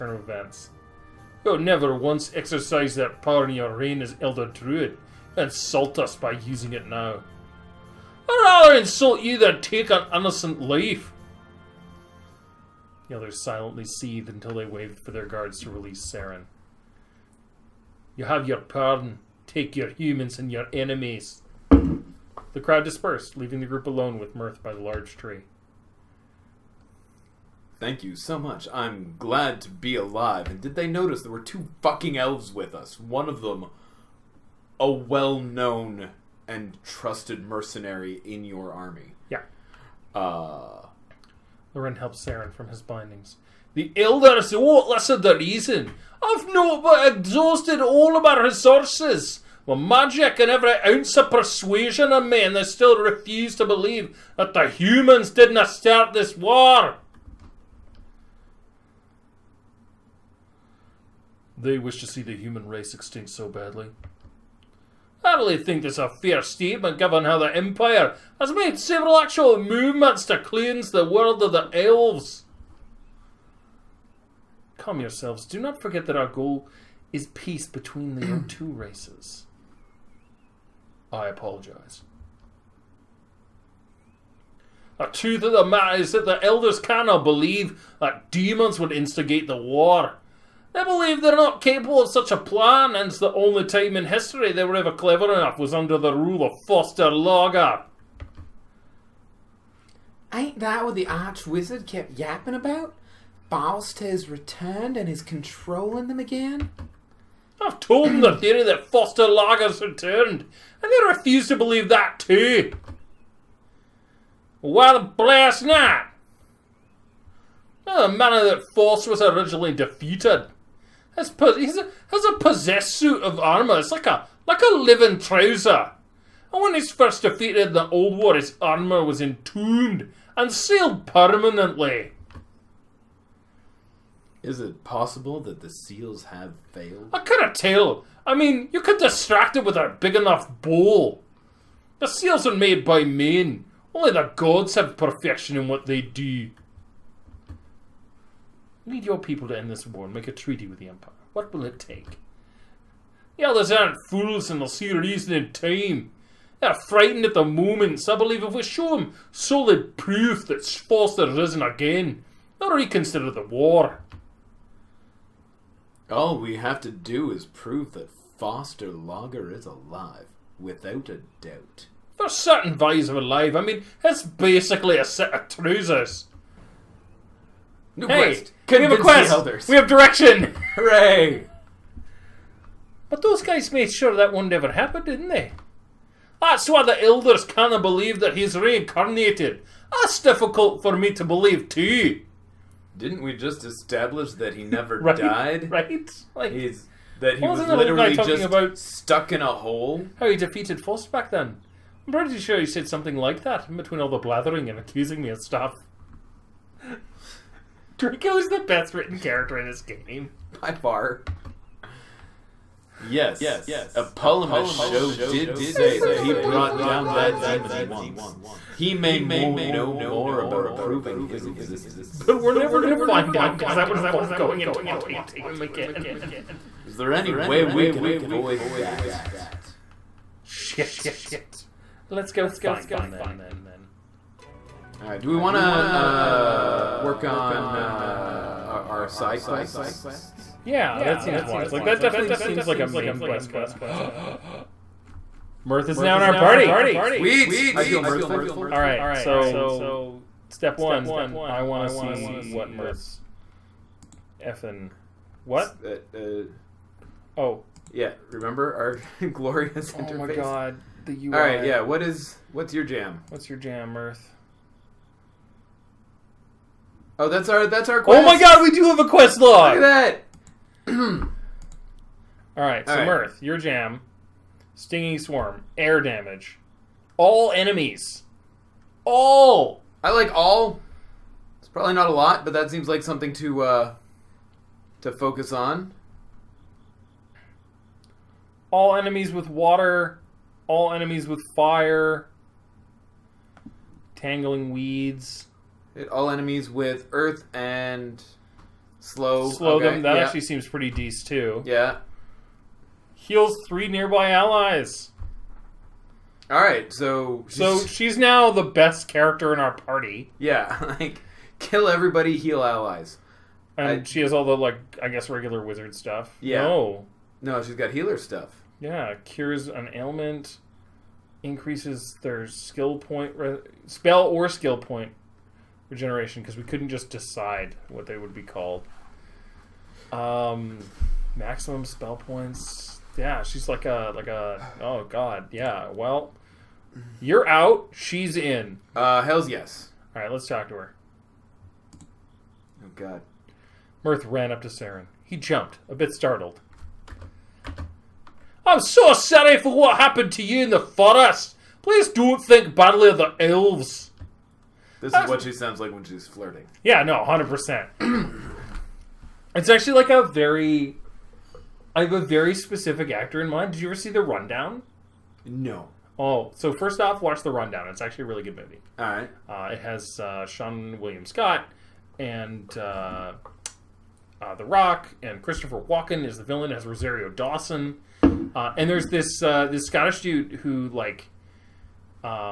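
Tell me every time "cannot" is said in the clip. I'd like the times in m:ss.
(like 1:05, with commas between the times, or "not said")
1:26, 3:07.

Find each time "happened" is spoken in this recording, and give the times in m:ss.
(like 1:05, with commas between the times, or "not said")
3:04, 5:49.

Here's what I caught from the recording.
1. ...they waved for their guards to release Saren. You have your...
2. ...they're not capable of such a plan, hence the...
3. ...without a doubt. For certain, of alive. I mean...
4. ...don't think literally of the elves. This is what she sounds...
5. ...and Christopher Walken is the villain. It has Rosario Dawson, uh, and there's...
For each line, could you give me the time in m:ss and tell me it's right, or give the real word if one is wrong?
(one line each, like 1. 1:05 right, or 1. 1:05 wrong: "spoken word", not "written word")
1. 0:14 right
2. 1:31 right
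3. 2:50 right
4. 5:52 wrong: "badly", not "literally"
5. 6:15 right.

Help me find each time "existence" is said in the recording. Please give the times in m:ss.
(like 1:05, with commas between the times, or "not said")
3:41.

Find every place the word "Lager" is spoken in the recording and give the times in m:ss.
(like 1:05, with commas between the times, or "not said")
1:49, 2:48.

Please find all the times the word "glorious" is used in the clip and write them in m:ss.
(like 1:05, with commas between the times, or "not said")
4:19.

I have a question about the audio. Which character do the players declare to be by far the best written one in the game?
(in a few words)
Draco.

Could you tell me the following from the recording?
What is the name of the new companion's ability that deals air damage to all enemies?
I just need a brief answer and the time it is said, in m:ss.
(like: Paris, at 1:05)
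Stinging swarm, at 4:34.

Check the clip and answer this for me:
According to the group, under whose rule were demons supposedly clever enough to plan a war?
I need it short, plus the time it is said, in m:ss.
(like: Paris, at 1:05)
Foster Logger, at 1:36.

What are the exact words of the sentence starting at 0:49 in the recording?
My magic and every ounce of persuasion in me, and they still refuse to believe that the humans didn't start this war.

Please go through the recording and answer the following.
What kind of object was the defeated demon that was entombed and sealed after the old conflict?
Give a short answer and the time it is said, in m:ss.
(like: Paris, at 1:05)
A possessed suit of armour, at 2:02.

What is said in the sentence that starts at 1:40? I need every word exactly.
Ain't that what the arch wizard kept yapping about?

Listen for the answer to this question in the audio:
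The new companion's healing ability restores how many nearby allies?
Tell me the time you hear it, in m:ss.
5:03.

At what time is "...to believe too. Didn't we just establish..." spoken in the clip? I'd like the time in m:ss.
3:11.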